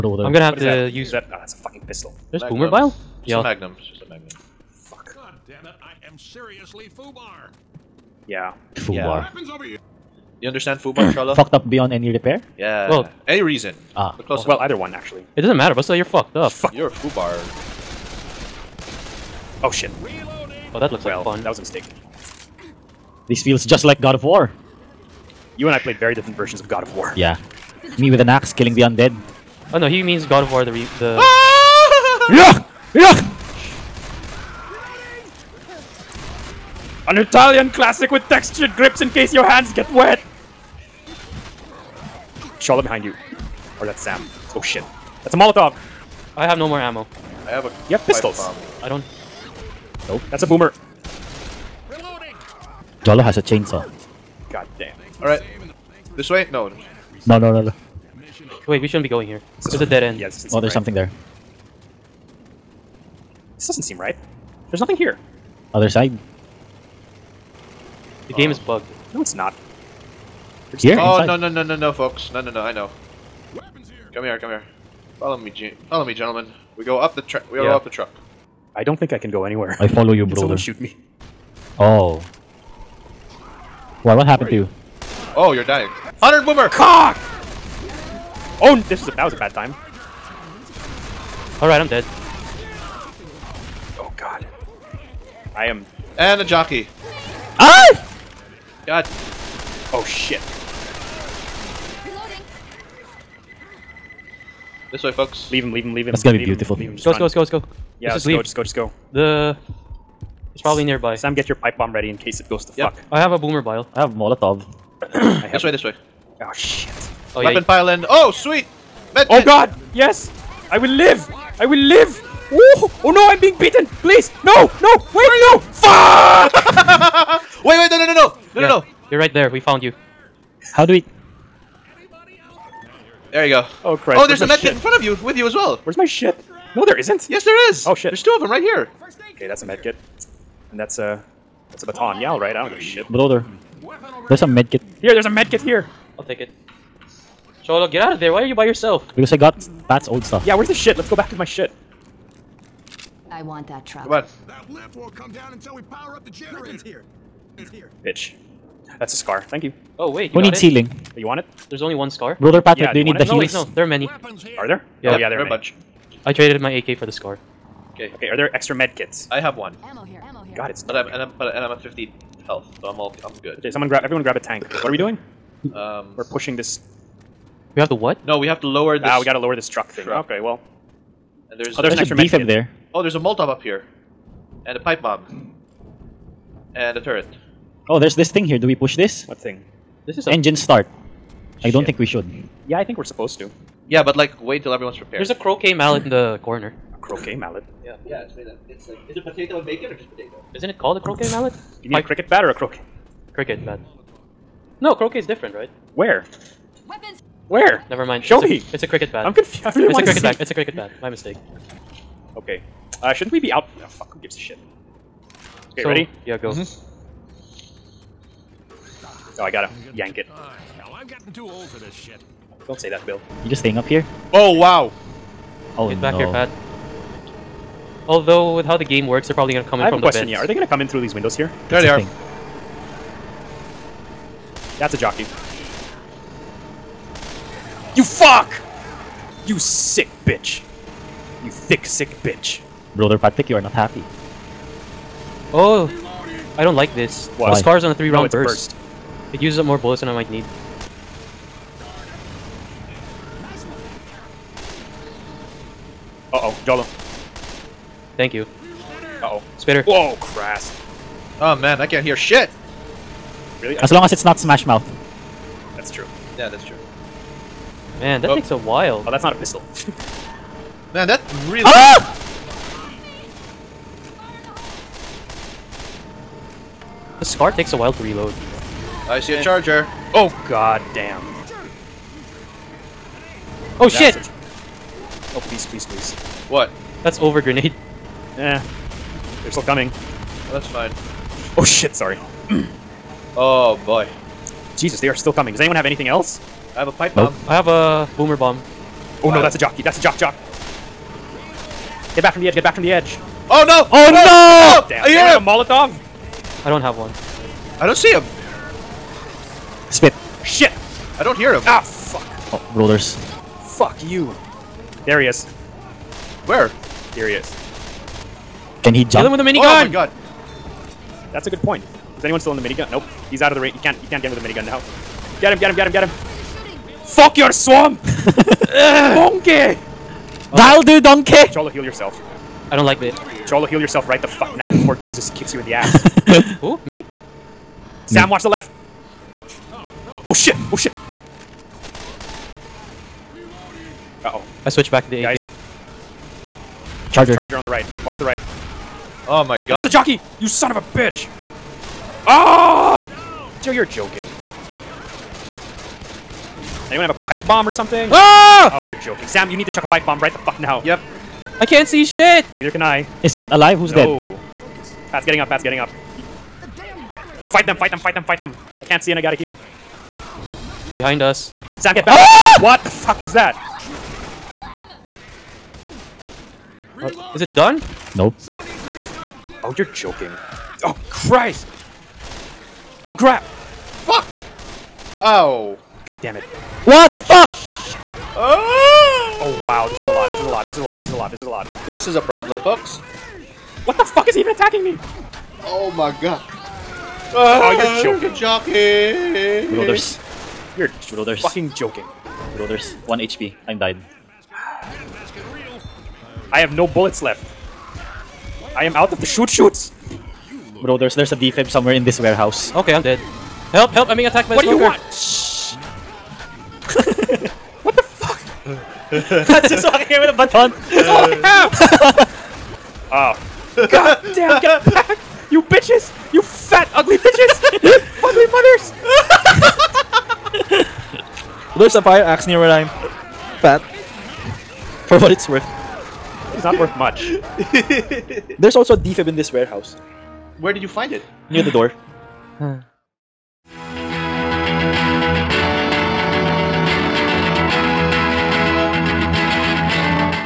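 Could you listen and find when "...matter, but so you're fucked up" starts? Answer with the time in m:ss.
0:15.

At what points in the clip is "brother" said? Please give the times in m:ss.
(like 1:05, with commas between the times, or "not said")
1:20, 2:23, 2:42, 4:02.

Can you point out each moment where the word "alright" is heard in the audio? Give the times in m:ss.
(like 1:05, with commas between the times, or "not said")
0:55, 2:22.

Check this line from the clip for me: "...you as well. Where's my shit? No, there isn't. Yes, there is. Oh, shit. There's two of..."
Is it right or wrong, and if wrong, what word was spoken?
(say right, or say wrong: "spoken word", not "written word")
right.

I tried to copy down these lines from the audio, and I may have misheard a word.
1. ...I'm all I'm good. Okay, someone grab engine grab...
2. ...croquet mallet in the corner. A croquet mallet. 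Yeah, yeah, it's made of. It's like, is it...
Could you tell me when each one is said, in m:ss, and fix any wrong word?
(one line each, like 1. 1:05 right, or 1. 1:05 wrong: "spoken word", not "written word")
1. 2:52 wrong: "everyone", not "engine"
2. 3:15 right.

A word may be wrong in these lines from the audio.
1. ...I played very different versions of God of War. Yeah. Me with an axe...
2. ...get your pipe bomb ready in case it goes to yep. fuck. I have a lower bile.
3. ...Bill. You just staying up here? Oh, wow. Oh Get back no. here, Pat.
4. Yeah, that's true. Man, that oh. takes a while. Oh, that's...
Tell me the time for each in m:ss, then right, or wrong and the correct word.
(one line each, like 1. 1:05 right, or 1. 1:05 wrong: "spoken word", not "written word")
1. 0:25 right
2. 1:51 wrong: "boomer", not "lower"
3. 3:43 right
4. 4:26 right.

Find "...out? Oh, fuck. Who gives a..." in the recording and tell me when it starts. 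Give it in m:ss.
3:33.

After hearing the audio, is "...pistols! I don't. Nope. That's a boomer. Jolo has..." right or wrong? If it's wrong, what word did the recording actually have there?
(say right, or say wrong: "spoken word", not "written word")
right.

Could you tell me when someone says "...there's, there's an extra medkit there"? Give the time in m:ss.
3:01.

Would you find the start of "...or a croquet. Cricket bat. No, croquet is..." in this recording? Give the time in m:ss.
3:22.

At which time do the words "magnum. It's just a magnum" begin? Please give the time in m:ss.
0:03.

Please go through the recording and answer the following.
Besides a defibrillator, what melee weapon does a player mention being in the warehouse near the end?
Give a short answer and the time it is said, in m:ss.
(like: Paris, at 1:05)
Fire axe, at 7:11.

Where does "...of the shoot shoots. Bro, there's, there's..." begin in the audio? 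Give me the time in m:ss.
6:49.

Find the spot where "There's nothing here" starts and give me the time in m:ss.
1:04.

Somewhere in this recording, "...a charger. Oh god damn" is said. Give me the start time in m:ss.
4:39.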